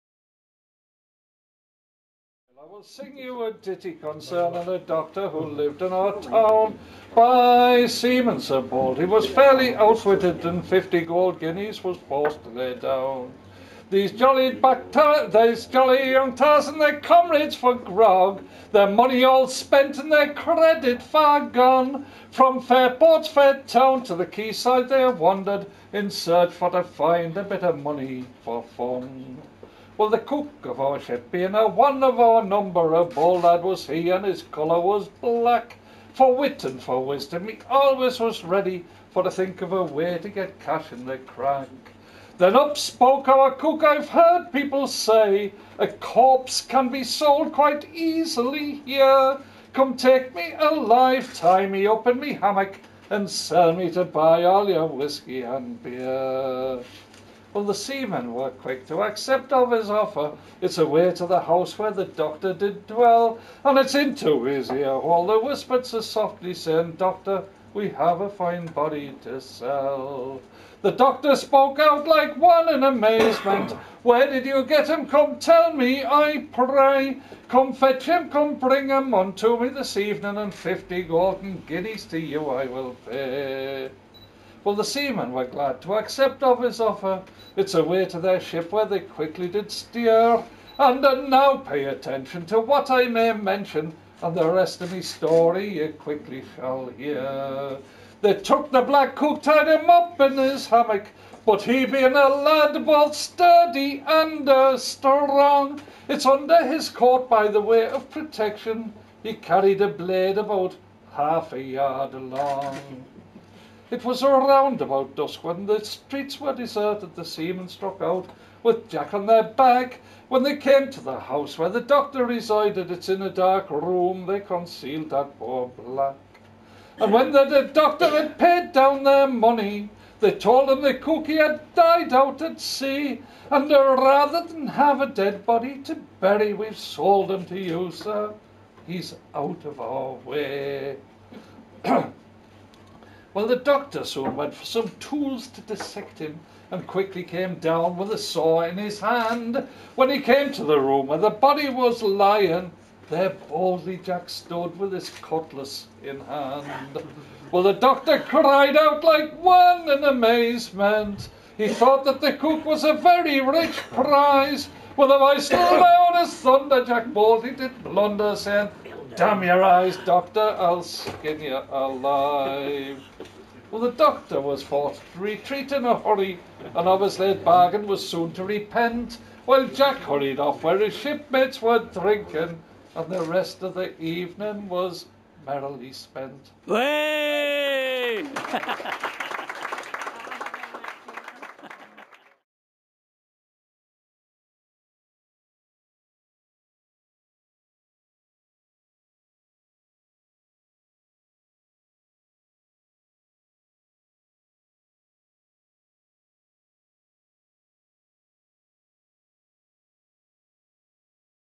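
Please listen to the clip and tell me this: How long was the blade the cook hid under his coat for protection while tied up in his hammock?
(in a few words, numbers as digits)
half a yard.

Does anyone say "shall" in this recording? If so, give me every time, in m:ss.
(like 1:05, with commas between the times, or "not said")
1:36.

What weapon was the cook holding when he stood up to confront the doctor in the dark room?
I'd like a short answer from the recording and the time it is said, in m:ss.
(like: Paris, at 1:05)
cutlass, at 2:35.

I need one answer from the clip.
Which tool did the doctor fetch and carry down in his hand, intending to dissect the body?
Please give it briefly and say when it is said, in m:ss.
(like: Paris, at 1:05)
saw, at 2:28.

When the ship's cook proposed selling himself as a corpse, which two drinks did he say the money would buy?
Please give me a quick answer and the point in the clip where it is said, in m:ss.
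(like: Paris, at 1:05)
whiskey and beer, at 0:54.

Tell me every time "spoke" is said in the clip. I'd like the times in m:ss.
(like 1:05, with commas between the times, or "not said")
0:42, 1:11.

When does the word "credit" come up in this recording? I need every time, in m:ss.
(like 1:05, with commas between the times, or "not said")
0:20.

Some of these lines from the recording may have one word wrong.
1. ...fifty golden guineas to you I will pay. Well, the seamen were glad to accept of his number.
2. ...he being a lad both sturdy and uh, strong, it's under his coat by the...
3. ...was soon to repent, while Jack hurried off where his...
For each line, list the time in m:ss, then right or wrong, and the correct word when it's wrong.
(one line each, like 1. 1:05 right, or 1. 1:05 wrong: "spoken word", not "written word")
1. 1:20 wrong: "offer", not "number"
2. 1:41 right
3. 2:57 right.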